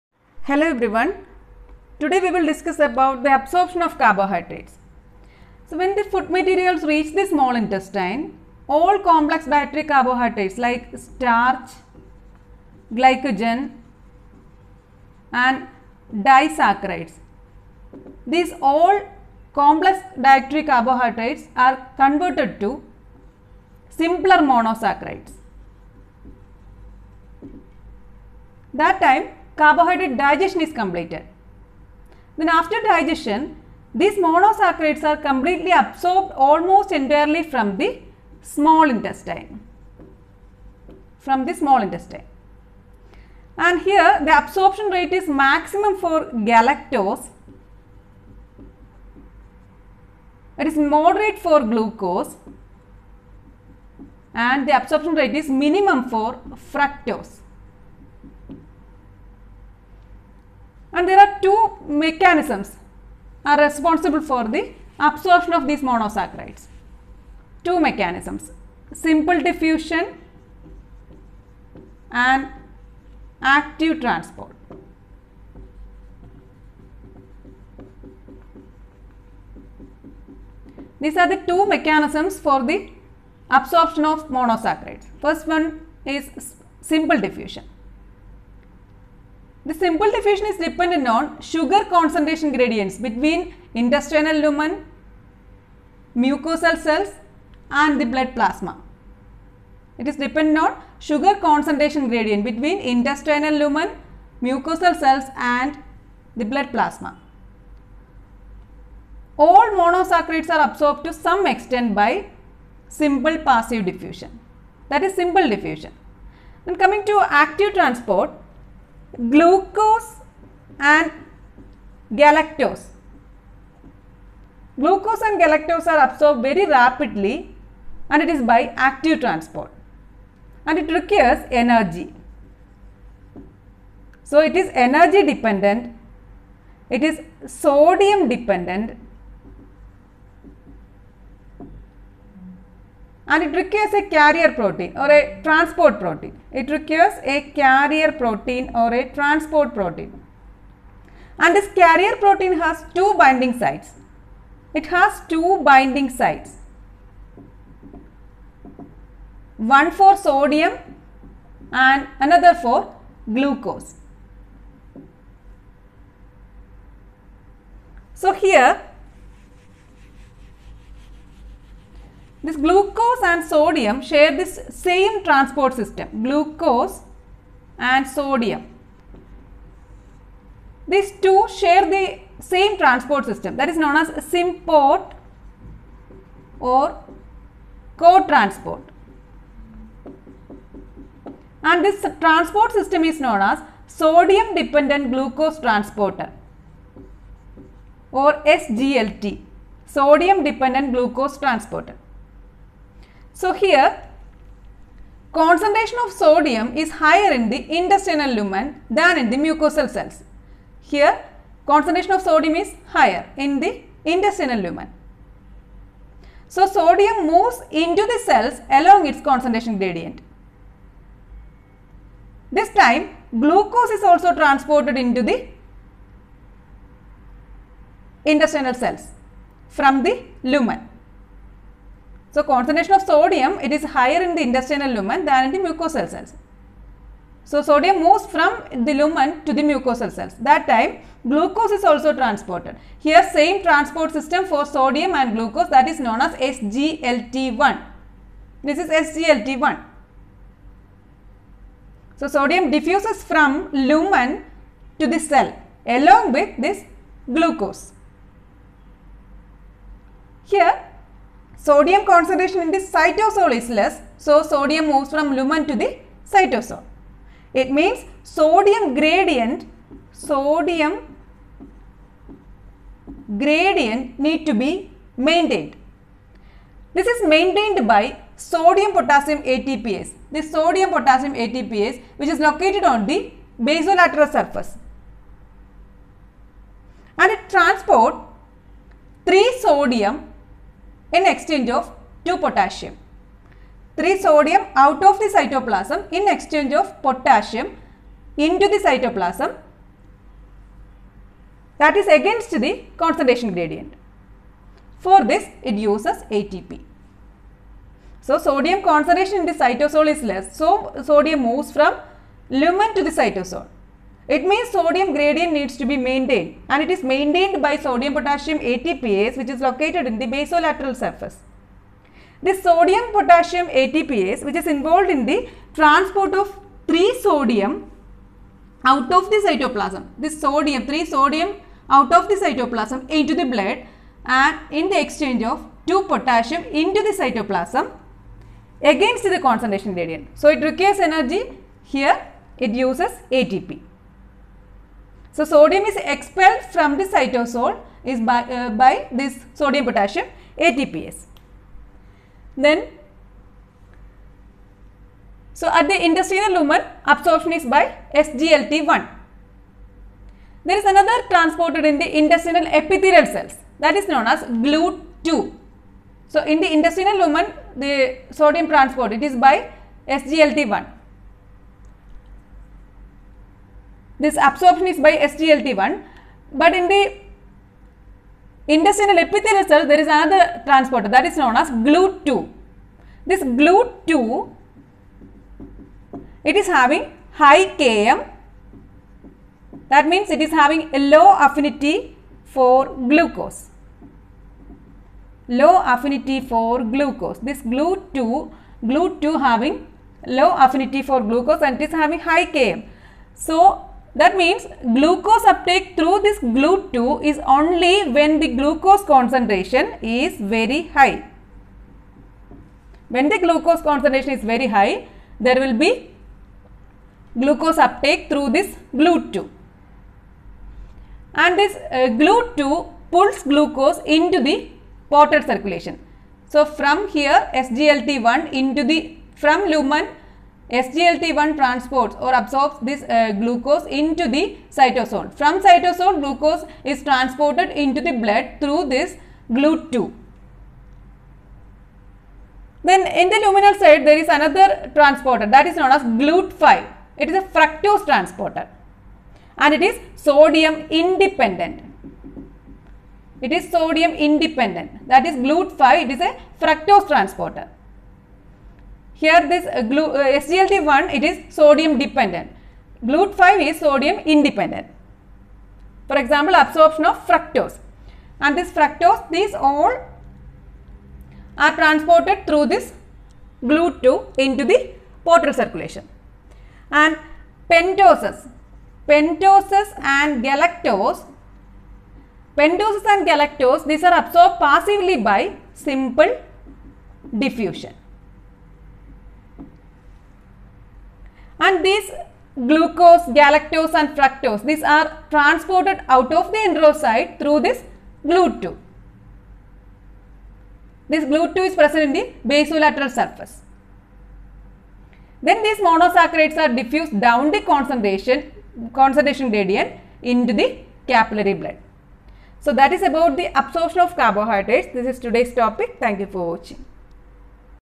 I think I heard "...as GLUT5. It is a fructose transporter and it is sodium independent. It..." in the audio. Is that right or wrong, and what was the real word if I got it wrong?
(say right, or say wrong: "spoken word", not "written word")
right.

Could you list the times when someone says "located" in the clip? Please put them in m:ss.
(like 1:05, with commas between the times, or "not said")
4:42, 5:19.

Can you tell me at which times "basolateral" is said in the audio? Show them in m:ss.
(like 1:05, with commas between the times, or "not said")
4:43, 5:20, 8:22.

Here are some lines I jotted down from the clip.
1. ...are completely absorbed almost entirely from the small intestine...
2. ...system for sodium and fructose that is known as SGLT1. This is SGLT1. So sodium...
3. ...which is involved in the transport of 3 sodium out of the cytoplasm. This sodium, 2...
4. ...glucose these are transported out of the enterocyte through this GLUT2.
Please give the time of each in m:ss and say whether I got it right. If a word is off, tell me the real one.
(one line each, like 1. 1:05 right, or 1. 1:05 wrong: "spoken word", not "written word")
1. 0:35 right
2. 4:04 wrong: "glucose", not "fructose"
3. 5:24 wrong: "3", not "2"
4. 8:14 wrong: "fructose", not "glucose".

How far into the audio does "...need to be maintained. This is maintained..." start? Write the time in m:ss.
4:34.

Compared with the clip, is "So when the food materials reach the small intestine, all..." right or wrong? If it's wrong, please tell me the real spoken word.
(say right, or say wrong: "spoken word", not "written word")
right.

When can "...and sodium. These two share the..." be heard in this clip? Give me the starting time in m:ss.
2:57.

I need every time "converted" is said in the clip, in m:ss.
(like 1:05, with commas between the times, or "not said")
0:22.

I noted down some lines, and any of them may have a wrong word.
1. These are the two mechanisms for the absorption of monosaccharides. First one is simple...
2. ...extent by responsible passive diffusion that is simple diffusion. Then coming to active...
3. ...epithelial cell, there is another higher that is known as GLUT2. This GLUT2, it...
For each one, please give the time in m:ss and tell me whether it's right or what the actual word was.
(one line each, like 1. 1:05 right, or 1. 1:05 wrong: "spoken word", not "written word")
1. 1:20 right
2. 1:51 wrong: "simple", not "responsible"
3. 6:19 wrong: "transporter", not "higher".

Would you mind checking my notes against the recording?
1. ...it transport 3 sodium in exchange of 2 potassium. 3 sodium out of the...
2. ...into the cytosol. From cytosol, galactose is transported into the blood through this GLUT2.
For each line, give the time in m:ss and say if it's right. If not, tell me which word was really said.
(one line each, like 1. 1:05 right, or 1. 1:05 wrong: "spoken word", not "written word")
1. 4:47 right
2. 7:13 wrong: "glucose", not "galactose".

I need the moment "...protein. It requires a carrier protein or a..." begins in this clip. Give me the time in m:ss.
2:25.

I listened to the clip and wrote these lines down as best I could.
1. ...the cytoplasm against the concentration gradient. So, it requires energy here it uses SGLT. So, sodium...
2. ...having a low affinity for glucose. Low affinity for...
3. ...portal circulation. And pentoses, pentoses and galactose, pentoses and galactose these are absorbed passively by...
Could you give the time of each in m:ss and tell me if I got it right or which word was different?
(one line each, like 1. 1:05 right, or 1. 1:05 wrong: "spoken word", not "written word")
1. 5:37 wrong: "ATP", not "SGLT"
2. 6:30 right
3. 7:55 right.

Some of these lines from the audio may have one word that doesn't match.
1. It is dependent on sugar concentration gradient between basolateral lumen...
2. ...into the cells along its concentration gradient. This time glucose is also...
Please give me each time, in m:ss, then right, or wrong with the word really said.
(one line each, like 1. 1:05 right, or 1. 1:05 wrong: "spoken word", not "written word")
1. 1:39 wrong: "intestinal", not "basolateral"
2. 3:37 right.